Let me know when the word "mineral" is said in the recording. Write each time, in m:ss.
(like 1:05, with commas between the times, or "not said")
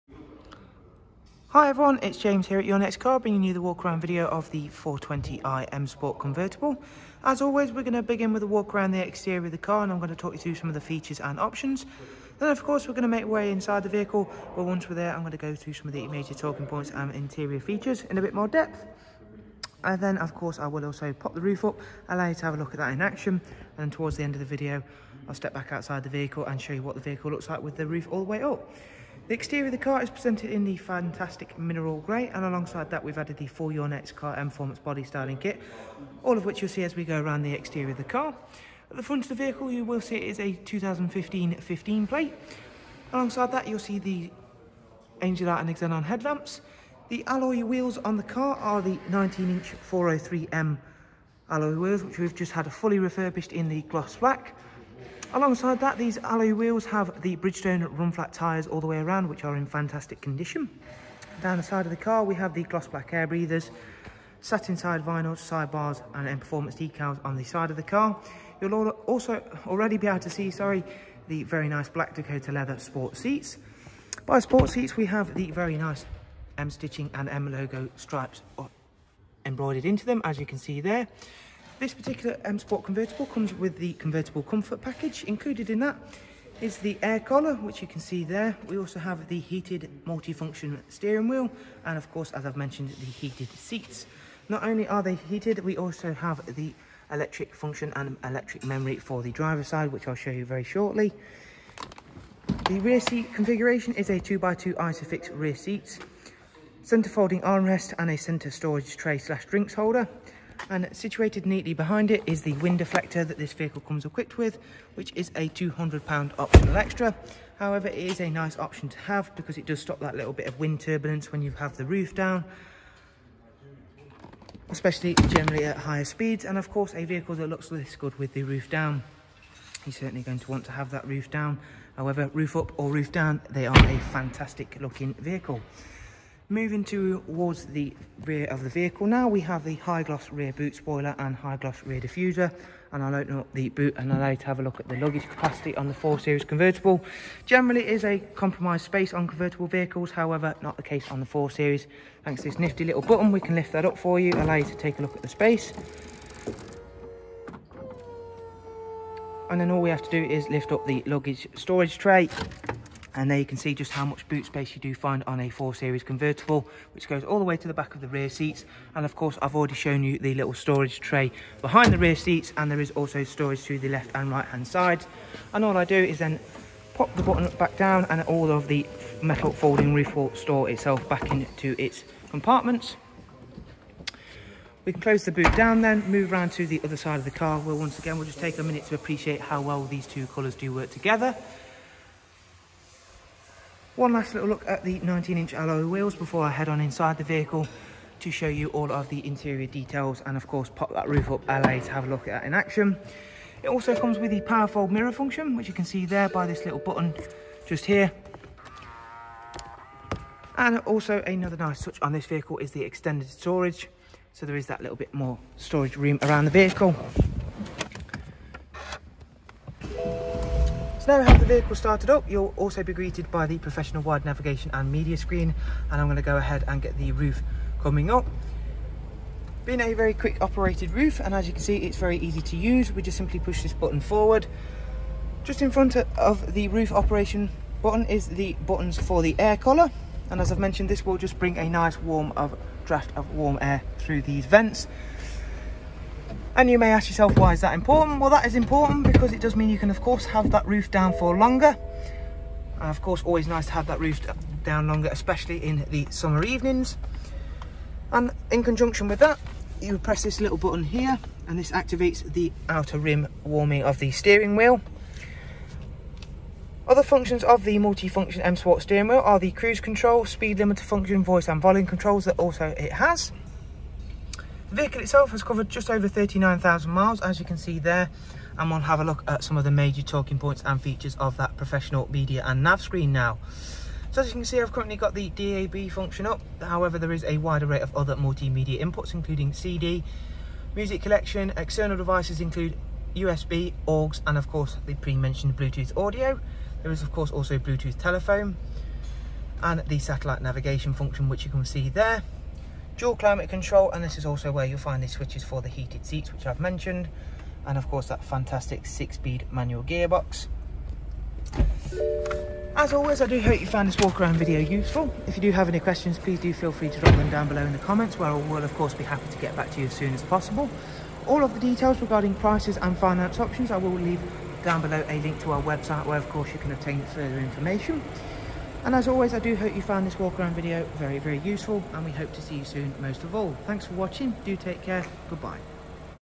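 0:31.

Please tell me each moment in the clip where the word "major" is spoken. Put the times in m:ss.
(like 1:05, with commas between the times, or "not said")
0:16, 4:39.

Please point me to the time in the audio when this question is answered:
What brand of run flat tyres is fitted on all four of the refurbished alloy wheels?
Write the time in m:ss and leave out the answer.
0:57.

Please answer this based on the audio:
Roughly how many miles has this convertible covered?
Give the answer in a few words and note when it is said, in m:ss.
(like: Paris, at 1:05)
39,000 miles, at 4:36.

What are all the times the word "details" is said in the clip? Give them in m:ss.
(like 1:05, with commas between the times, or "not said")
3:19, 5:21.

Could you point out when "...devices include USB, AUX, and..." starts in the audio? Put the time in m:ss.
4:51.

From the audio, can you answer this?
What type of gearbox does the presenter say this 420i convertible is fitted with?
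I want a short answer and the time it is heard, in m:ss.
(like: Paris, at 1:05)
Six-speed manual, at 5:08.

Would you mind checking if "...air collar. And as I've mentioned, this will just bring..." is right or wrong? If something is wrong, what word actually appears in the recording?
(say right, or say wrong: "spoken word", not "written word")
right.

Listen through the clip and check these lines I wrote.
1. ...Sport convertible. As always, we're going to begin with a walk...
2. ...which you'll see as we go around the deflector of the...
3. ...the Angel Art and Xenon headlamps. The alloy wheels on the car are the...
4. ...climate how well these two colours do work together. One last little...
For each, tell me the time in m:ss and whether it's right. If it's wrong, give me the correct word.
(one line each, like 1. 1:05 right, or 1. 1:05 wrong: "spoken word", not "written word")
1. 0:05 right
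2. 0:36 wrong: "exterior", not "deflector"
3. 0:43 right
4. 3:08 wrong: "appreciate", not "climate".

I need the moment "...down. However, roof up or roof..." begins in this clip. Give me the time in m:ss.
2:11.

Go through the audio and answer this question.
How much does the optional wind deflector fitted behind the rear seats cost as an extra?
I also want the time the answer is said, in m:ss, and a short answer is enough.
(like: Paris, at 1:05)
£200, at 1:55.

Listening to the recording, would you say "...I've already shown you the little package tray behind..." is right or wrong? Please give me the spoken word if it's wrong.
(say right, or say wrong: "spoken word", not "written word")
wrong: "storage", not "package".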